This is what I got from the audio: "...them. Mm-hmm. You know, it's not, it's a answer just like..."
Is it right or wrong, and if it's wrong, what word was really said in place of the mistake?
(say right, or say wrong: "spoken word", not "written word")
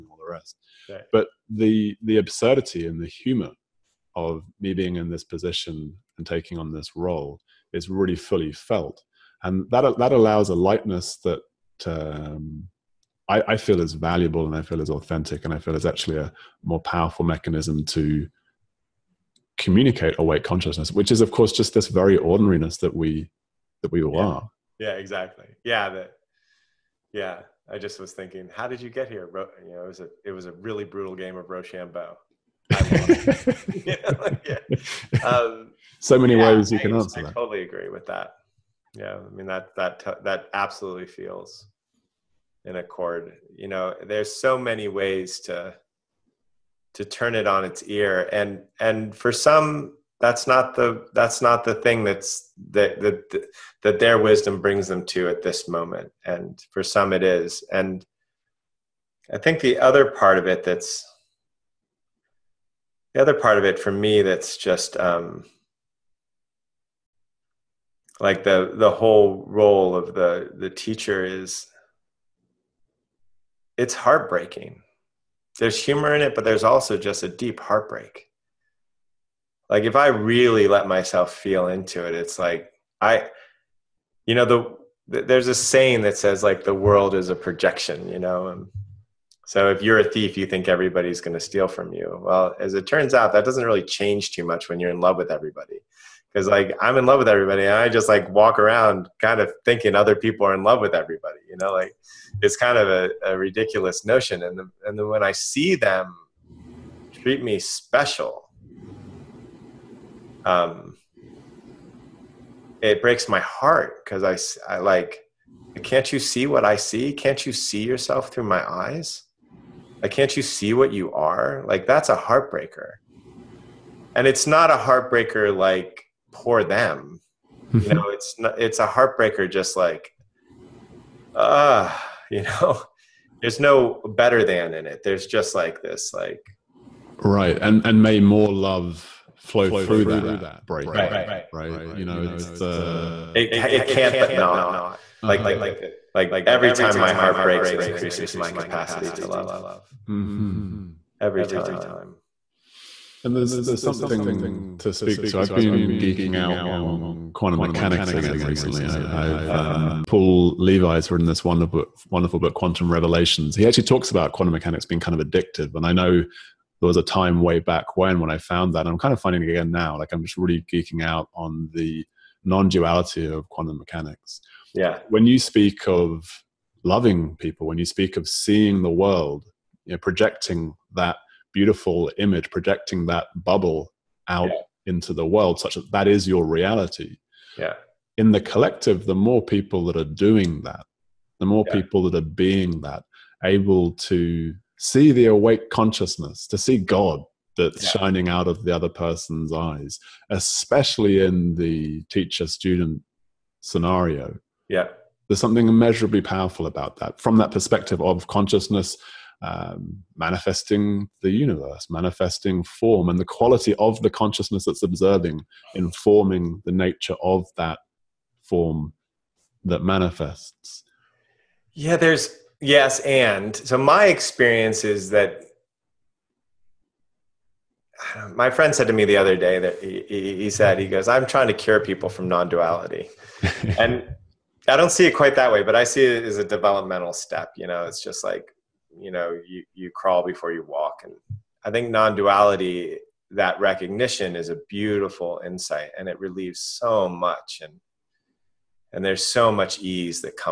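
wrong: "heartbreaker", not "answer".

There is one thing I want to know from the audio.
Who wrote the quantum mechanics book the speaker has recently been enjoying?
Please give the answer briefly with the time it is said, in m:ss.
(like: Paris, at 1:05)
Paul Levy, at 2:40.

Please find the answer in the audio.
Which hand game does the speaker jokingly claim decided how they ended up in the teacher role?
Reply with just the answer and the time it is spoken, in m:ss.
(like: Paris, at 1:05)
Rochambeau, at 0:31.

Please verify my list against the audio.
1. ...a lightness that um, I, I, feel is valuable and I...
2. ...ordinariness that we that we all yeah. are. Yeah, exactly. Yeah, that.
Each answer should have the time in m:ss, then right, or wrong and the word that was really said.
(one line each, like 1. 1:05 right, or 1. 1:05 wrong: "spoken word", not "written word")
1. 0:10 right
2. 0:22 right.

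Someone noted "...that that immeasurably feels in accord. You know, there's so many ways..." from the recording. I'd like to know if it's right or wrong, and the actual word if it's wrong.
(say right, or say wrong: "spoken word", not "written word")
wrong: "absolutely", not "immeasurably".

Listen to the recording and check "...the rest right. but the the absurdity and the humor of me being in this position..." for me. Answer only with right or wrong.
right.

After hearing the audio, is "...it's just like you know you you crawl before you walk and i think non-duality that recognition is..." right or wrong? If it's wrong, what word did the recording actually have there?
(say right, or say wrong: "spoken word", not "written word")
right.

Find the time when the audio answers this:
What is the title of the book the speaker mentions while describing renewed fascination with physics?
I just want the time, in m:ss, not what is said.
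2:42.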